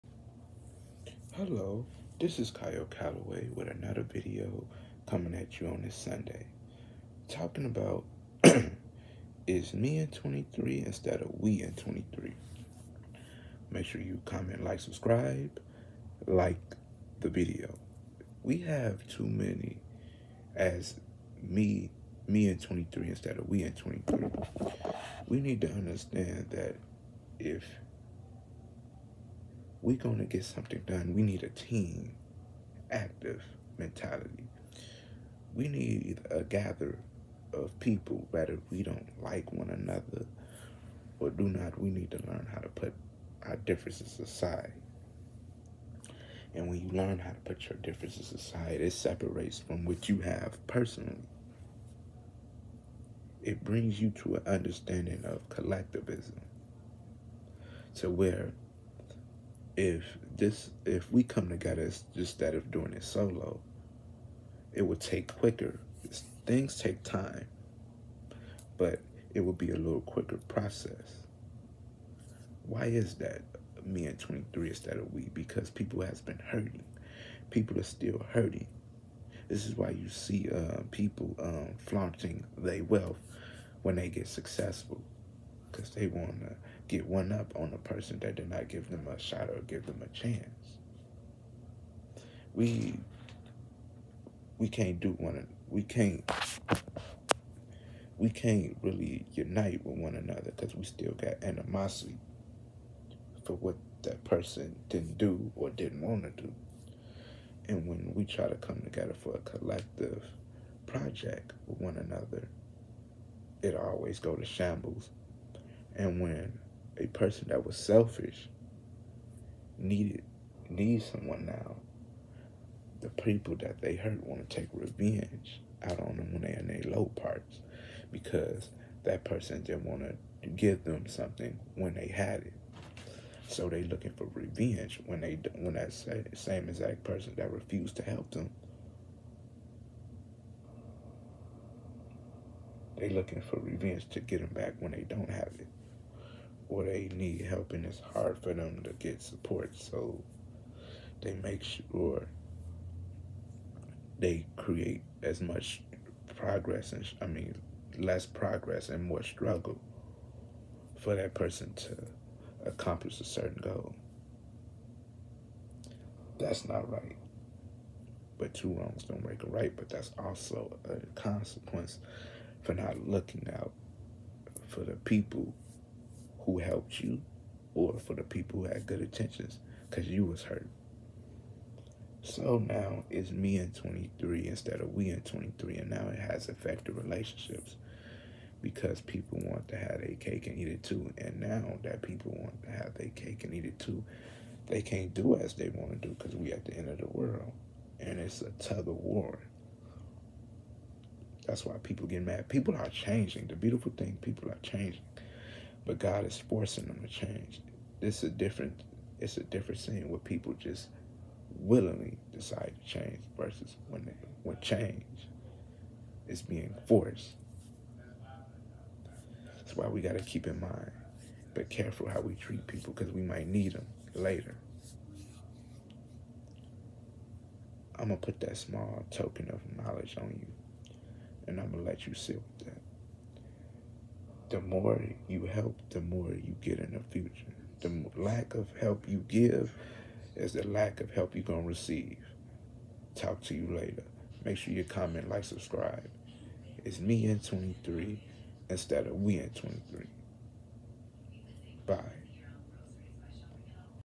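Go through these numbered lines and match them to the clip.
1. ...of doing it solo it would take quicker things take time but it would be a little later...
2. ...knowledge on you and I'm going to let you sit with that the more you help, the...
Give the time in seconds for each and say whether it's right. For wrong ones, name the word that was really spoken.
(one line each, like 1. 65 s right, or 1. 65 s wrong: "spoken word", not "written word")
1. 62 s wrong: "quicker", not "later"
2. 229 s right.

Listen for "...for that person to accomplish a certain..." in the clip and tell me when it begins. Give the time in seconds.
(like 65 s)
160 s.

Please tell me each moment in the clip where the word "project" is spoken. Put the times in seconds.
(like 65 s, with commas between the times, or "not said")
110 s.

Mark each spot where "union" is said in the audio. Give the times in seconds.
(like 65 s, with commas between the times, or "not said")
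not said.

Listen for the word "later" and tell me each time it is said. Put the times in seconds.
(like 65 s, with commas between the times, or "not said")
224 s, 243 s.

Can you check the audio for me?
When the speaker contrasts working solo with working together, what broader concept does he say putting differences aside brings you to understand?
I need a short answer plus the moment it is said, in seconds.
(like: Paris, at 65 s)
collectivism, at 55 s.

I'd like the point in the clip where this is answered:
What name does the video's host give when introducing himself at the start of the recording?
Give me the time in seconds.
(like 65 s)
2 s.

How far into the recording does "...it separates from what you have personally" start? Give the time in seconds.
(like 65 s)
48 s.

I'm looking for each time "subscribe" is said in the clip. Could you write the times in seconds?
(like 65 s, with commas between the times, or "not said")
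14 s, 245 s.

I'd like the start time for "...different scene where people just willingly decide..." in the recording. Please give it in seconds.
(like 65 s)
209 s.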